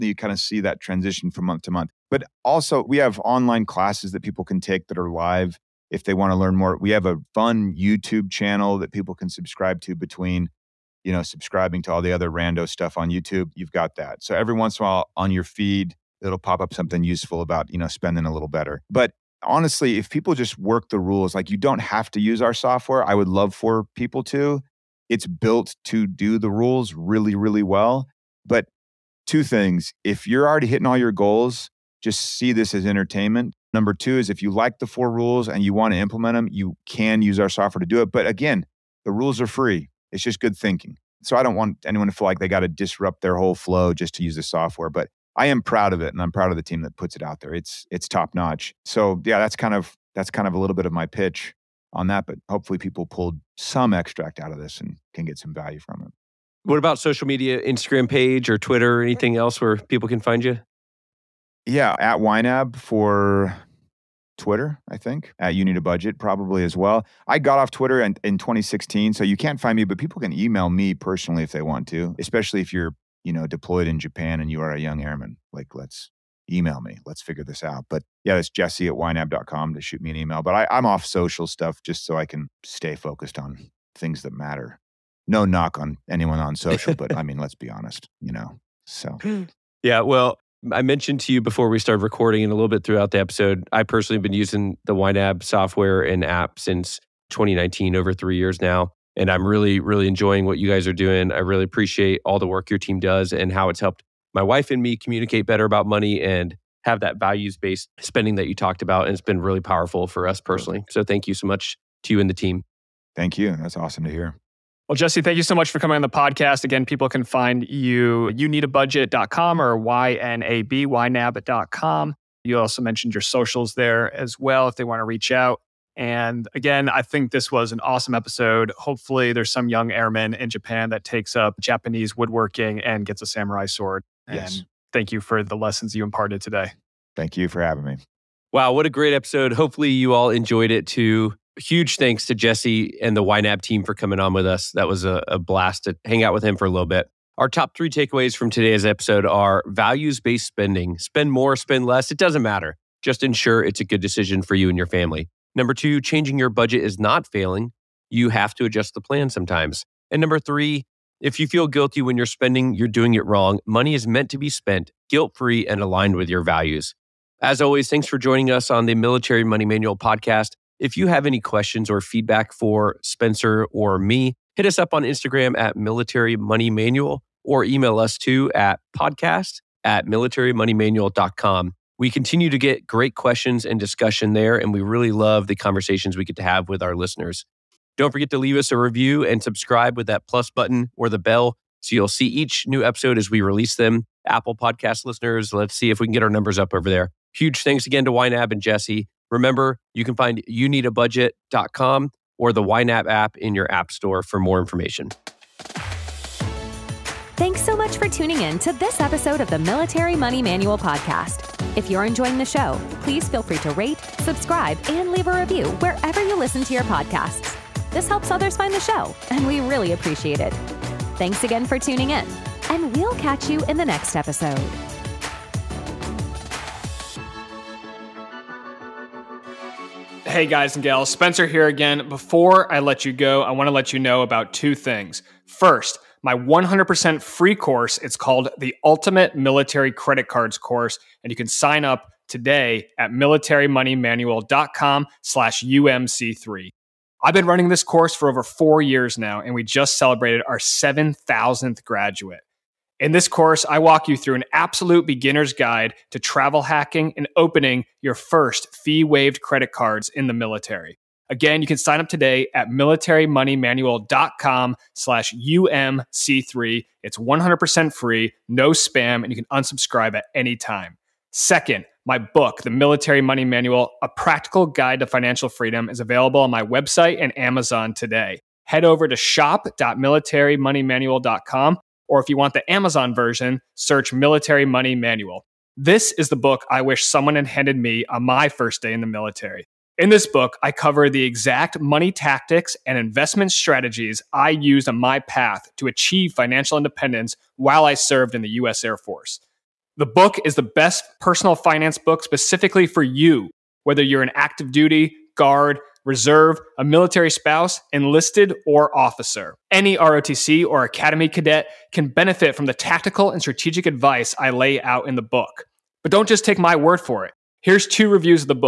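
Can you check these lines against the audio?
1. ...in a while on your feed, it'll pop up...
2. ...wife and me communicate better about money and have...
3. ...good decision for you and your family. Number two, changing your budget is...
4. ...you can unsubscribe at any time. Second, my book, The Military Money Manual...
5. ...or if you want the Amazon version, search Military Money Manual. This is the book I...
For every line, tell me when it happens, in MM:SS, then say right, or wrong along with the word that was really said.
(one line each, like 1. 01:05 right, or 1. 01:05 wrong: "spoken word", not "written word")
1. 00:14 right
2. 01:44 right
3. 02:33 right
4. 04:29 right
5. 04:42 right.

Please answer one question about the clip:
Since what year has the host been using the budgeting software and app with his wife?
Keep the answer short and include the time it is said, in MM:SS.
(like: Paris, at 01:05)
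2019, at 01:37.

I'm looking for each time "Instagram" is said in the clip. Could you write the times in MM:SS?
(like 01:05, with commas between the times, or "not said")
00:57, 02:55.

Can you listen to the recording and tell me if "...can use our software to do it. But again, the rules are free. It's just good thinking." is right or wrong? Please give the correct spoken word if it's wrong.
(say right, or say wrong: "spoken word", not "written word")
right.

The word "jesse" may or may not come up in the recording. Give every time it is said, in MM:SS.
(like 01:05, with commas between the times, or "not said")
01:18, 01:54, 02:22, 03:18.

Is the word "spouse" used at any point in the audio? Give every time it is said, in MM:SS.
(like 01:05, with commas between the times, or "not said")
05:07.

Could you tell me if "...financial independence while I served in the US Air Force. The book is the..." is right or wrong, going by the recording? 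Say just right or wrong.
right.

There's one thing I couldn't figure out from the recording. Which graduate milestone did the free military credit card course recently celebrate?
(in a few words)
7,000th.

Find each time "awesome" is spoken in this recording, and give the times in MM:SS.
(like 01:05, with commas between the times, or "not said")
01:53, 02:07.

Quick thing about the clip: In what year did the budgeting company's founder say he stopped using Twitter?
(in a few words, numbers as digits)
2016.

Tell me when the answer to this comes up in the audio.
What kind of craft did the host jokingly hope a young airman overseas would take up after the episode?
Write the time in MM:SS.
02:11.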